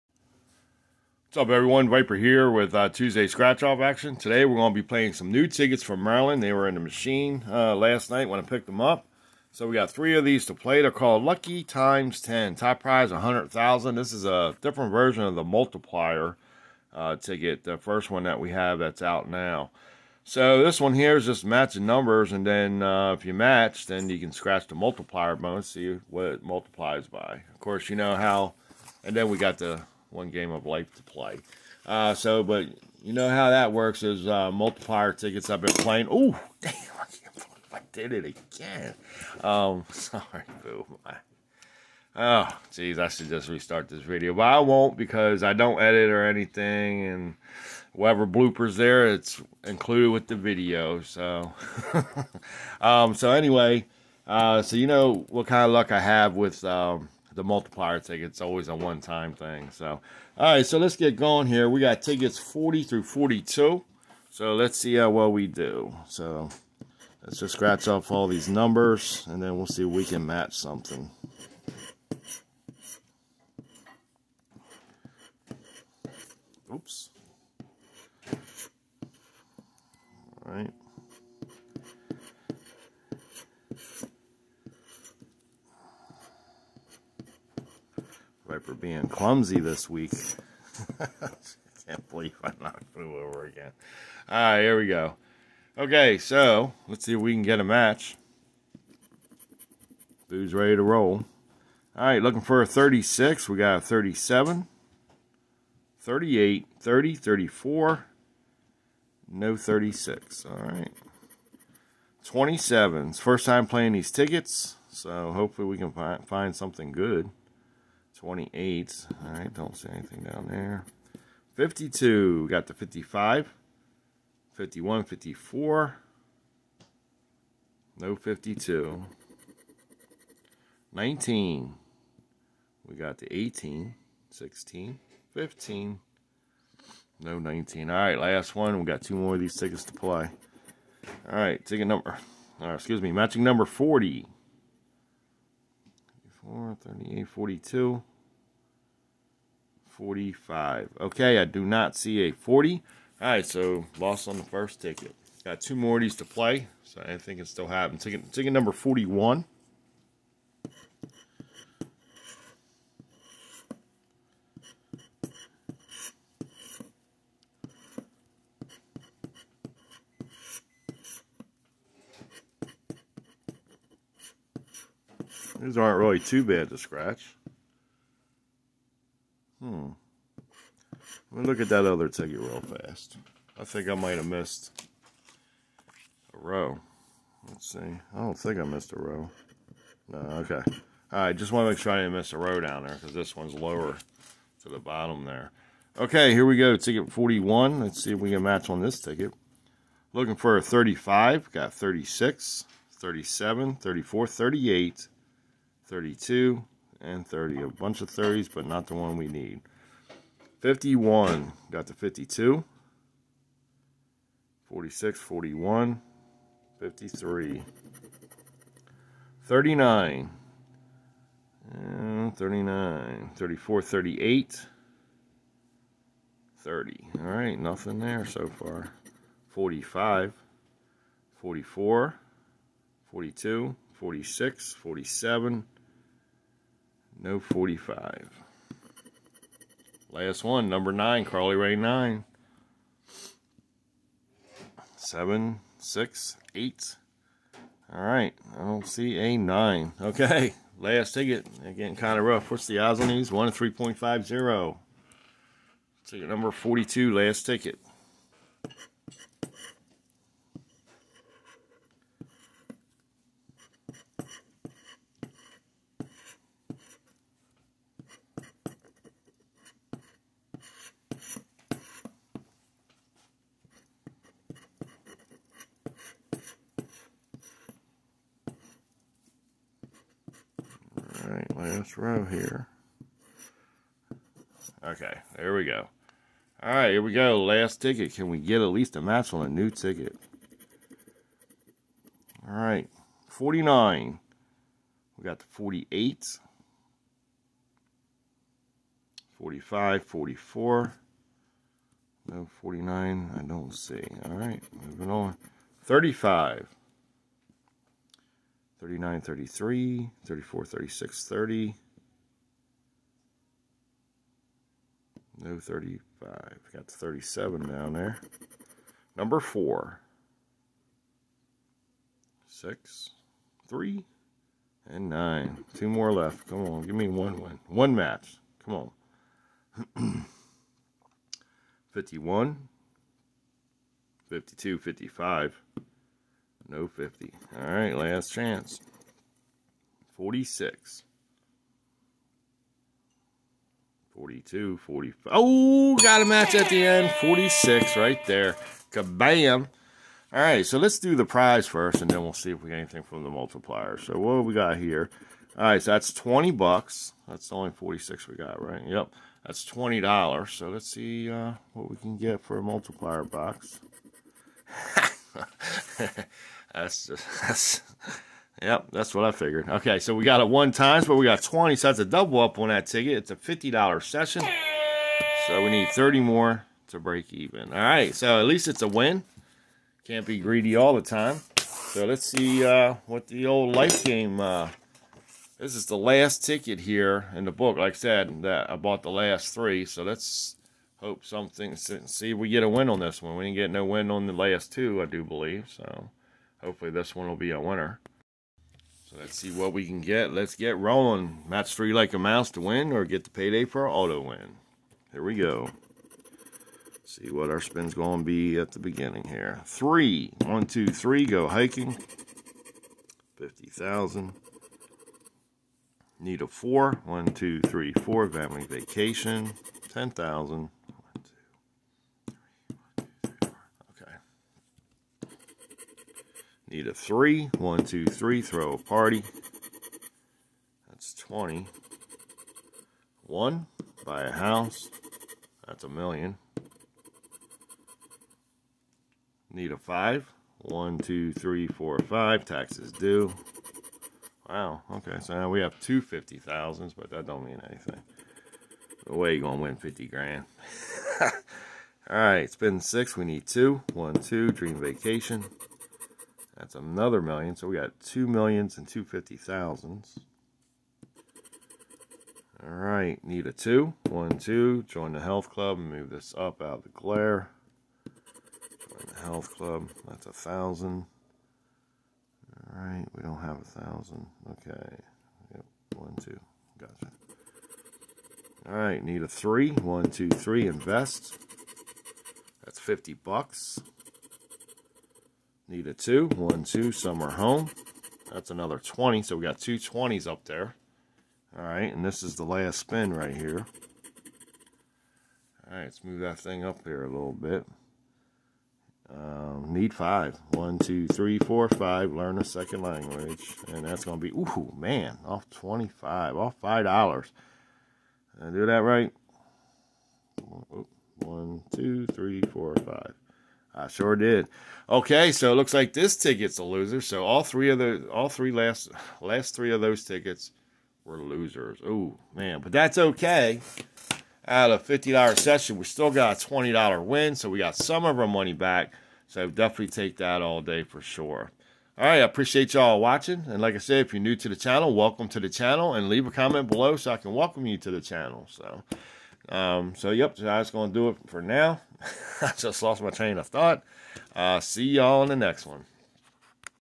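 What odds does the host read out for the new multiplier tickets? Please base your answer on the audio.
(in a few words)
1 in 3.50.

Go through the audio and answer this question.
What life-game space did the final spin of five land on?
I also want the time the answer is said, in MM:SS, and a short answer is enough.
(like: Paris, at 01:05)
Learn a second language, at 08:22.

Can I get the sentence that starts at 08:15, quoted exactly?
All right, let's move that thing up here a little bit.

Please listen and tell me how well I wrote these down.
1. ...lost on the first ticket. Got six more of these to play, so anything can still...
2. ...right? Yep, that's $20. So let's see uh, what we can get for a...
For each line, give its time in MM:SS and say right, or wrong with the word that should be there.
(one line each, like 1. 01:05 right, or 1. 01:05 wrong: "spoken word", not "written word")
1. 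02:33 wrong: "two", not "six"
2. 05:58 right.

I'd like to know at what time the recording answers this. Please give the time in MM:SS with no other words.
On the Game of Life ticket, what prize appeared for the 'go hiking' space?
06:53.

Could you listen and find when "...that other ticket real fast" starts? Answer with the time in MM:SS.
03:01.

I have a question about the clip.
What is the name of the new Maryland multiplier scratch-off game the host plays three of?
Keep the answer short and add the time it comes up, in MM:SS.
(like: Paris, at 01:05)
Lucky Times 10, at 00:11.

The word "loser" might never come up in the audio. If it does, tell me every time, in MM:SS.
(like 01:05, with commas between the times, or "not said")
08:36, 08:41.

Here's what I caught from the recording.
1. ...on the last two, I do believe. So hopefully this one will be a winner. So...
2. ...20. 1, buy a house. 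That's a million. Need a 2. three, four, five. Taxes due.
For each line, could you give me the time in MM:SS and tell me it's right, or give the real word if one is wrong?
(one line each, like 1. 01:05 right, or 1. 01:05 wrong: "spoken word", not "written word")
1. 06:34 right
2. 07:11 wrong: "5", not "2".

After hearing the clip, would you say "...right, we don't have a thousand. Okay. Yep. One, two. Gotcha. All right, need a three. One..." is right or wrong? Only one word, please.
right.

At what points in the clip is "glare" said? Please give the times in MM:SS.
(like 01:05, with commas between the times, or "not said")
07:46.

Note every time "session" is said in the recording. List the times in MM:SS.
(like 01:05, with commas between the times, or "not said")
06:14, 08:45.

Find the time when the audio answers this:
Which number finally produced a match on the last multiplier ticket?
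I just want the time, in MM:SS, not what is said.
05:47.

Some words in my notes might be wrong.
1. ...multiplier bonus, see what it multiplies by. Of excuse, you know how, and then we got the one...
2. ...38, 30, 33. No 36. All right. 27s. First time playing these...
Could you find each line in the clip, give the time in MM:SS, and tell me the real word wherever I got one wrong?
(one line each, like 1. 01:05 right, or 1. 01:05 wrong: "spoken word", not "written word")
1. 00:24 wrong: "course", not "excuse"
2. 01:45 wrong: "34", not "33".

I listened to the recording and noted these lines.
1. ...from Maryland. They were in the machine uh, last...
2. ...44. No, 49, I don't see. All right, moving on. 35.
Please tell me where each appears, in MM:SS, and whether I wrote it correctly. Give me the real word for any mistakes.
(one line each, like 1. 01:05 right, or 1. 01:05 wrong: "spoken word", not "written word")
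1. 00:05 right
2. 05:00 right.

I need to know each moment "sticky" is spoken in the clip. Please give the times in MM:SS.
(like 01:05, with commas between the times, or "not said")
not said.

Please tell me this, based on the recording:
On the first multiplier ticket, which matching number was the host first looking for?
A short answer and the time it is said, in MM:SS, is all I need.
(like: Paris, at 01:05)
36, at 01:42.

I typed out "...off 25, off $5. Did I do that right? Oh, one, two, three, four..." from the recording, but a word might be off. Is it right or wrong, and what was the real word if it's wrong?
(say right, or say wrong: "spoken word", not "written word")
right.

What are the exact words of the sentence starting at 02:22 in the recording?
Uh, excuse me, matching number 40.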